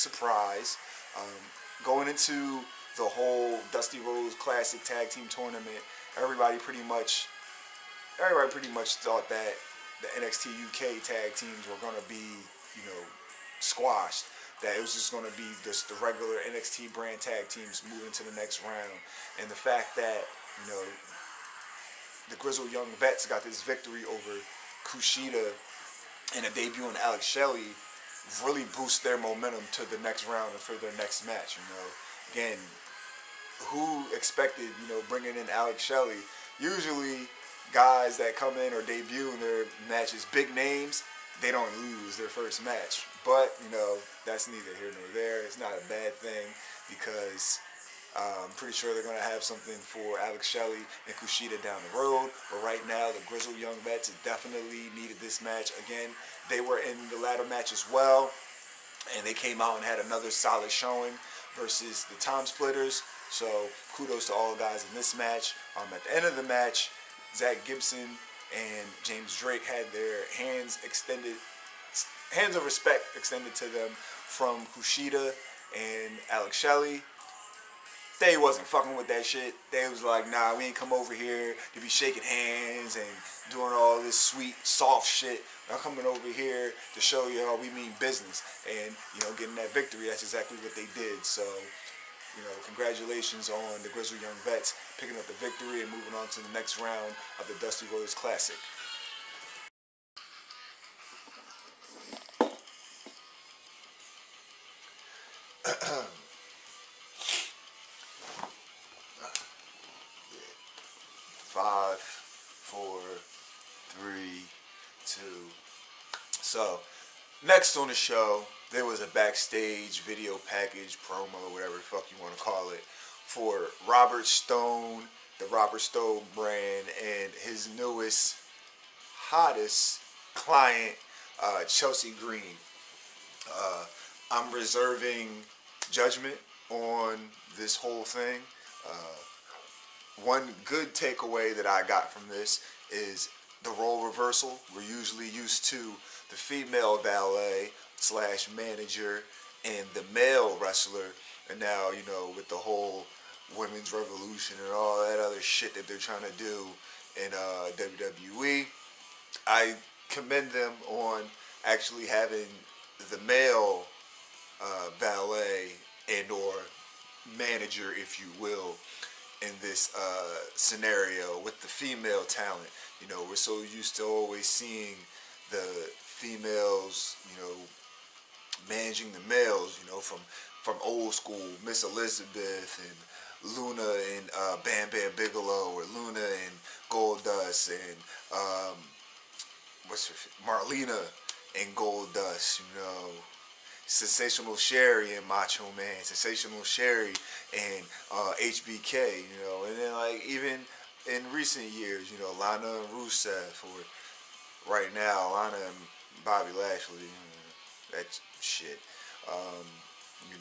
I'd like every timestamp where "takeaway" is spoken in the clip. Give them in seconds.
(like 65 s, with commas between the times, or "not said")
140 s.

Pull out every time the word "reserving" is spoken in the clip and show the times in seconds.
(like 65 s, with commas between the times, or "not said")
134 s.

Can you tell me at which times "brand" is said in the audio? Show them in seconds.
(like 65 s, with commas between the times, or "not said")
16 s, 126 s.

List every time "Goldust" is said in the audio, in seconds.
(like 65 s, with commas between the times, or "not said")
186 s, 191 s.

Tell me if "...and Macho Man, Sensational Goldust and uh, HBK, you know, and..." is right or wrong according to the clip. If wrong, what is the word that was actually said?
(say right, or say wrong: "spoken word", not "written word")
wrong: "Sherri", not "Goldust".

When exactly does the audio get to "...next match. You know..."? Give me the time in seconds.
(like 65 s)
30 s.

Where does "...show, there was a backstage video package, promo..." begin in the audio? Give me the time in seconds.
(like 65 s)
117 s.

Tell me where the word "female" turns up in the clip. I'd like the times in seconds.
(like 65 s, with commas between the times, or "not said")
146 s, 171 s, 176 s.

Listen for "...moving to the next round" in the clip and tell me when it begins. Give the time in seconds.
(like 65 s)
17 s.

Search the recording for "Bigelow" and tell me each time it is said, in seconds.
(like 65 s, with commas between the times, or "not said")
185 s.